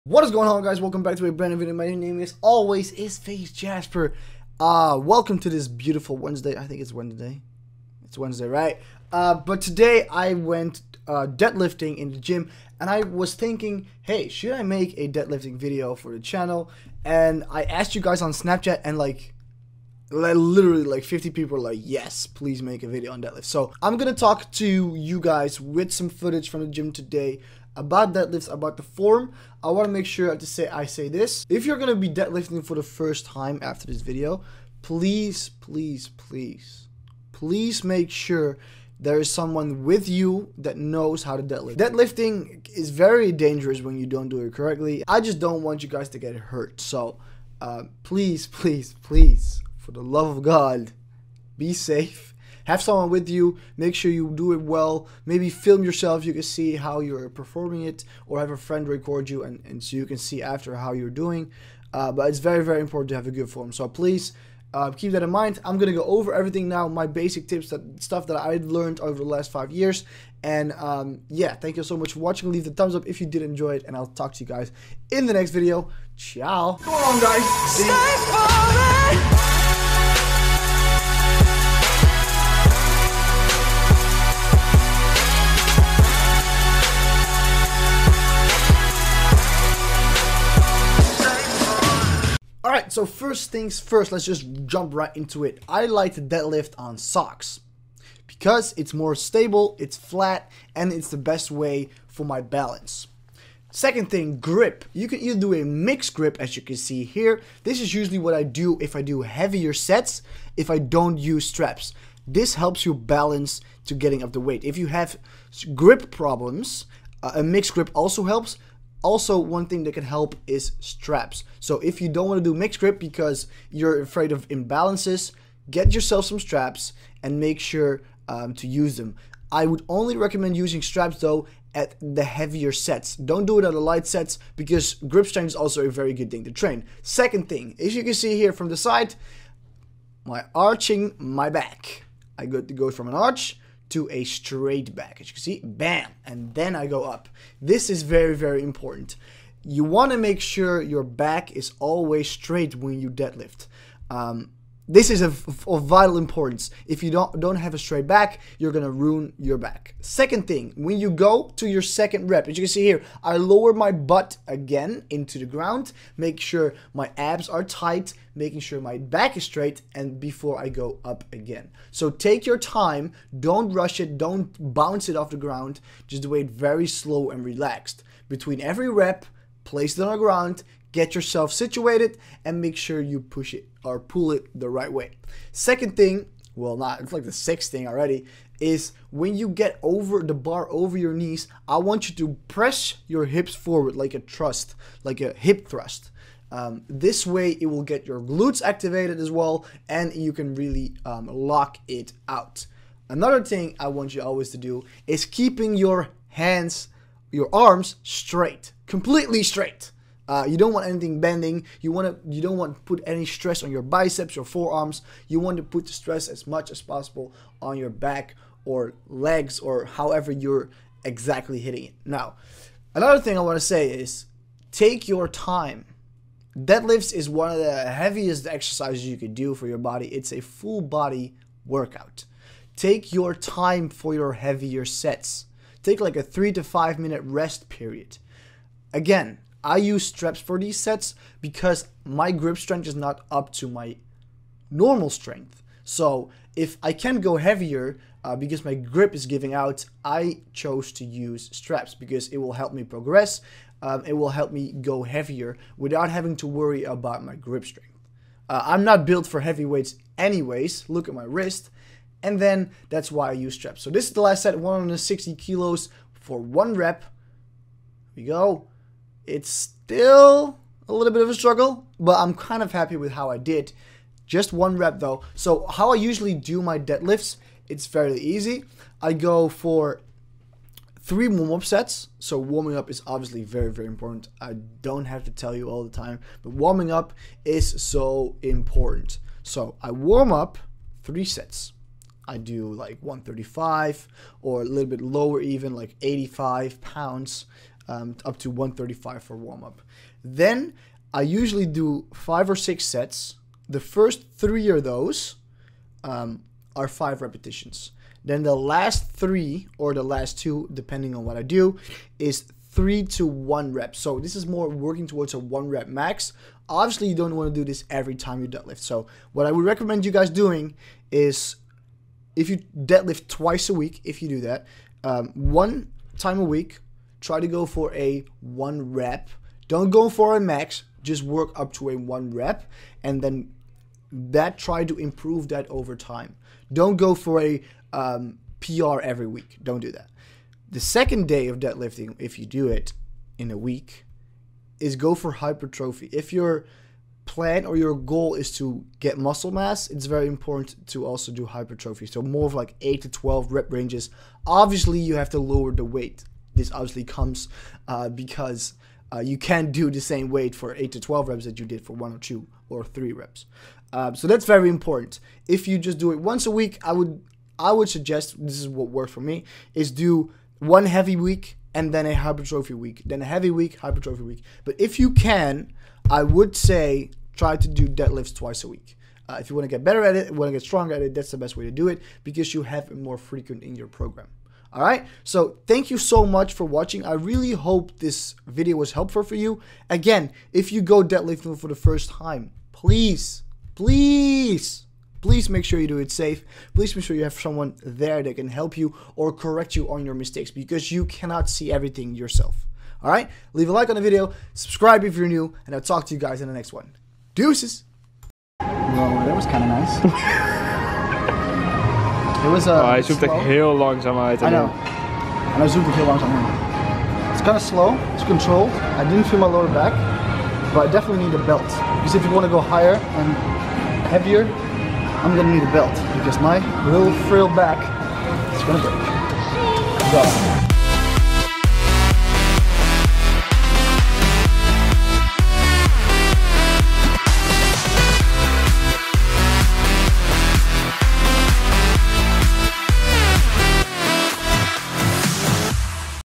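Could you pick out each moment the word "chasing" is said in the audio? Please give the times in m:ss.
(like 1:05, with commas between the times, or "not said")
not said.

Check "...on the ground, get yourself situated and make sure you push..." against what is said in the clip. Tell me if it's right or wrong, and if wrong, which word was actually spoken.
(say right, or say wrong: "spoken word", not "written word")
right.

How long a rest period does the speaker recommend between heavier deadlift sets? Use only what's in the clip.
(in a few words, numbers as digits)
3 to 5 minutes.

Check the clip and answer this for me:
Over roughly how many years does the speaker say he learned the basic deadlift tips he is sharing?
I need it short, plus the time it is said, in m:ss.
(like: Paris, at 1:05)
5 years, at 1:09.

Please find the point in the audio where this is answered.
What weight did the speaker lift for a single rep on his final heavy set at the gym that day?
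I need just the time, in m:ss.
4:24.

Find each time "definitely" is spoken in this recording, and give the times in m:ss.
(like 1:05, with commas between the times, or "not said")
7:00.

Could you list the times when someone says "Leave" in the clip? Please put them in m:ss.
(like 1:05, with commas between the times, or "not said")
1:12, 6:43.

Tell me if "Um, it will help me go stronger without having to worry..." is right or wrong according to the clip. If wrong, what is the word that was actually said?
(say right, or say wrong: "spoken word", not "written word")
wrong: "heavier", not "stronger".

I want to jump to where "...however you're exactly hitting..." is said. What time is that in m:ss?
3:39.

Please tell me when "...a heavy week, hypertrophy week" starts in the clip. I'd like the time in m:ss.
6:13.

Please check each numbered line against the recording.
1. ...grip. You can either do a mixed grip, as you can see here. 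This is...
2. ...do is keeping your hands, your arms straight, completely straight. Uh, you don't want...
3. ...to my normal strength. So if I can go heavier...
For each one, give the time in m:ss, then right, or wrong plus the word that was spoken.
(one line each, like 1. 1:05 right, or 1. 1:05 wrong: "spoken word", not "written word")
1. 1:44 right
2. 3:24 right
3. 4:03 right.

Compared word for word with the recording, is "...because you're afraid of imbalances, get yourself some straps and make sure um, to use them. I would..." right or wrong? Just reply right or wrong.
right.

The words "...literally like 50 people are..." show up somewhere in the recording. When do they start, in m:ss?
0:20.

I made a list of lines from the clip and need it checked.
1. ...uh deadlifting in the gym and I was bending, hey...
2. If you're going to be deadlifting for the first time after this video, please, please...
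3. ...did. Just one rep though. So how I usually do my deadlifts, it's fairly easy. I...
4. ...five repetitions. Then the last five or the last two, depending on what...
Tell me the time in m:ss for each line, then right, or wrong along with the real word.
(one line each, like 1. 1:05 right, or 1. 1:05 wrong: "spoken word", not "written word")
1. 0:11 wrong: "thinking", not "bending"
2. 0:31 right
3. 4:33 right
4. 5:06 wrong: "three", not "five".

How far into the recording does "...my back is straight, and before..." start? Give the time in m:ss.
2:48.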